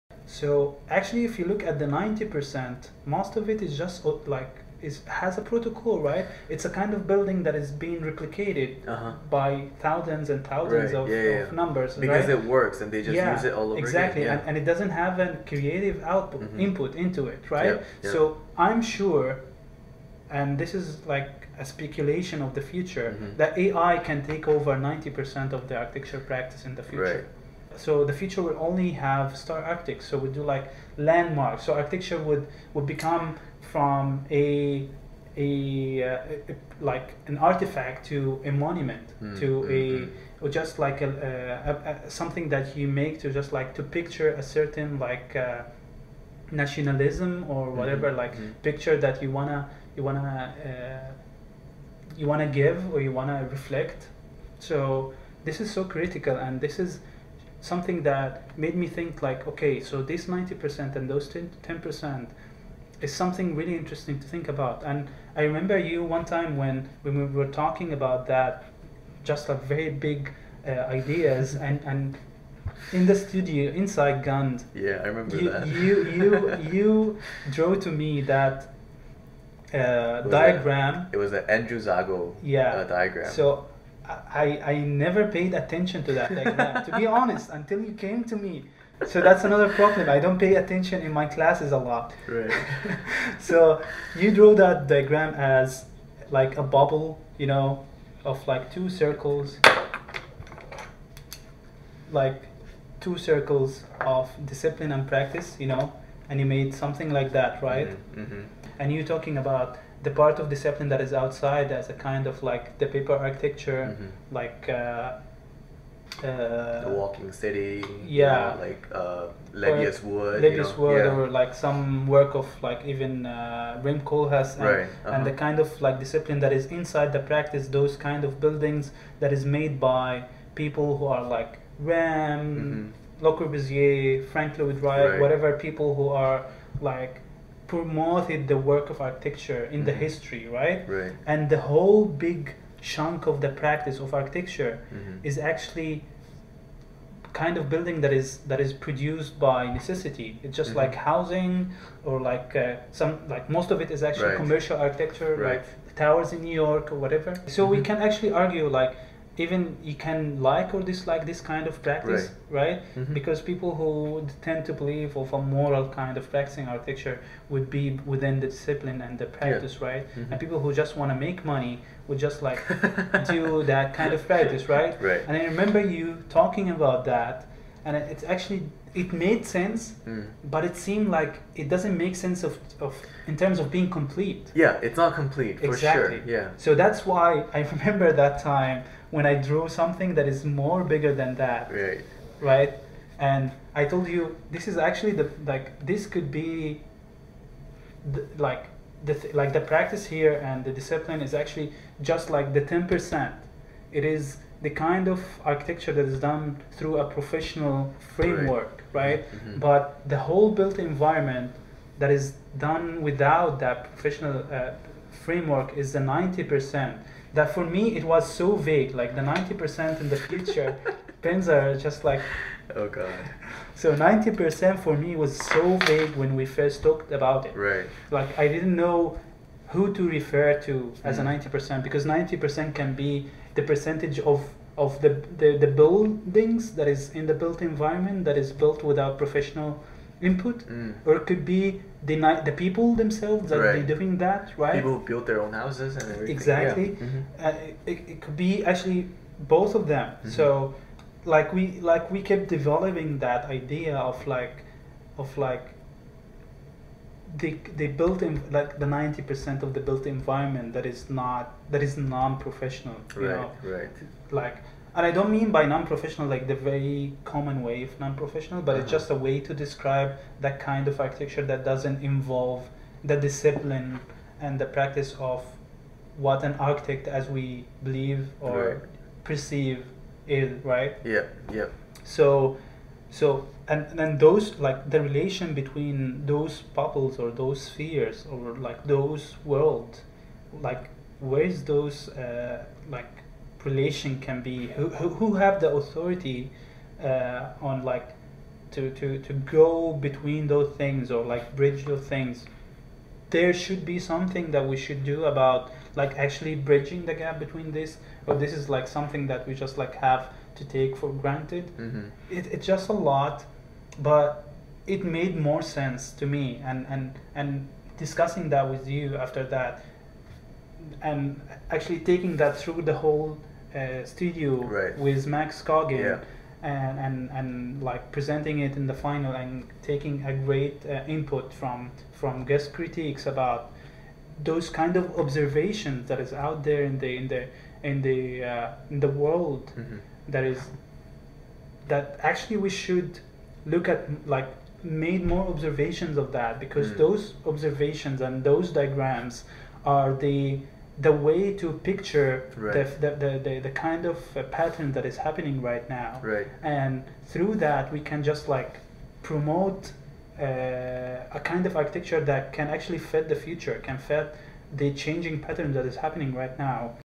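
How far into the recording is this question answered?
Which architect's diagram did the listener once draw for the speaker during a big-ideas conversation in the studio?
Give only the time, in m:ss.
1:21.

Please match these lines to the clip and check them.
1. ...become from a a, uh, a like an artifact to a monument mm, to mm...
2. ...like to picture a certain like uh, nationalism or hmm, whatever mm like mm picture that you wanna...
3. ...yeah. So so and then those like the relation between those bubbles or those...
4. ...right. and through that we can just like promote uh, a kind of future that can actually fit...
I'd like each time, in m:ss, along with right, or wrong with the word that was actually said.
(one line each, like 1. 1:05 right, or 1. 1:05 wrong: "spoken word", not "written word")
1. 0:32 right
2. 0:43 right
3. 4:41 right
4. 5:56 wrong: "architecture", not "future".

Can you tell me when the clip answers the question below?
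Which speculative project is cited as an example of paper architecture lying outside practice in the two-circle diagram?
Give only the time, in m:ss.
1:56.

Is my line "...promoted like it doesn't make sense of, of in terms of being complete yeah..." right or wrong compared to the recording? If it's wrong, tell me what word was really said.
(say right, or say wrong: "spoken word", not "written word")
wrong: "seemed", not "promoted".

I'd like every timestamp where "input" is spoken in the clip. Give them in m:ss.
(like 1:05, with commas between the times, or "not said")
0:16, 4:00, 5:31.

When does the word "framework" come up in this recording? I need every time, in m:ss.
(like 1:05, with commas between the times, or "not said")
3:28, 3:35.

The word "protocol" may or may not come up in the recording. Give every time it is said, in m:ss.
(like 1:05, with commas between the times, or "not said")
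0:05.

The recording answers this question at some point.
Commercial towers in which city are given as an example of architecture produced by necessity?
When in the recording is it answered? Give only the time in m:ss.
2:36.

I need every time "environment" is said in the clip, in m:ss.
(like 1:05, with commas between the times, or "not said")
3:30, 3:57, 4:20.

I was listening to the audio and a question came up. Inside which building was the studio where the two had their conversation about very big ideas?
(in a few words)
Gund.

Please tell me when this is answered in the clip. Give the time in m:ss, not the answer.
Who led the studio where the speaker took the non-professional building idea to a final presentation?
5:25.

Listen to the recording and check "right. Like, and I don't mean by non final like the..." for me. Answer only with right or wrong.
wrong.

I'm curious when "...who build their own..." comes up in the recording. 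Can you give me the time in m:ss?
4:04.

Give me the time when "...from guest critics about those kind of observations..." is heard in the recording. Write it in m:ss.
5:32.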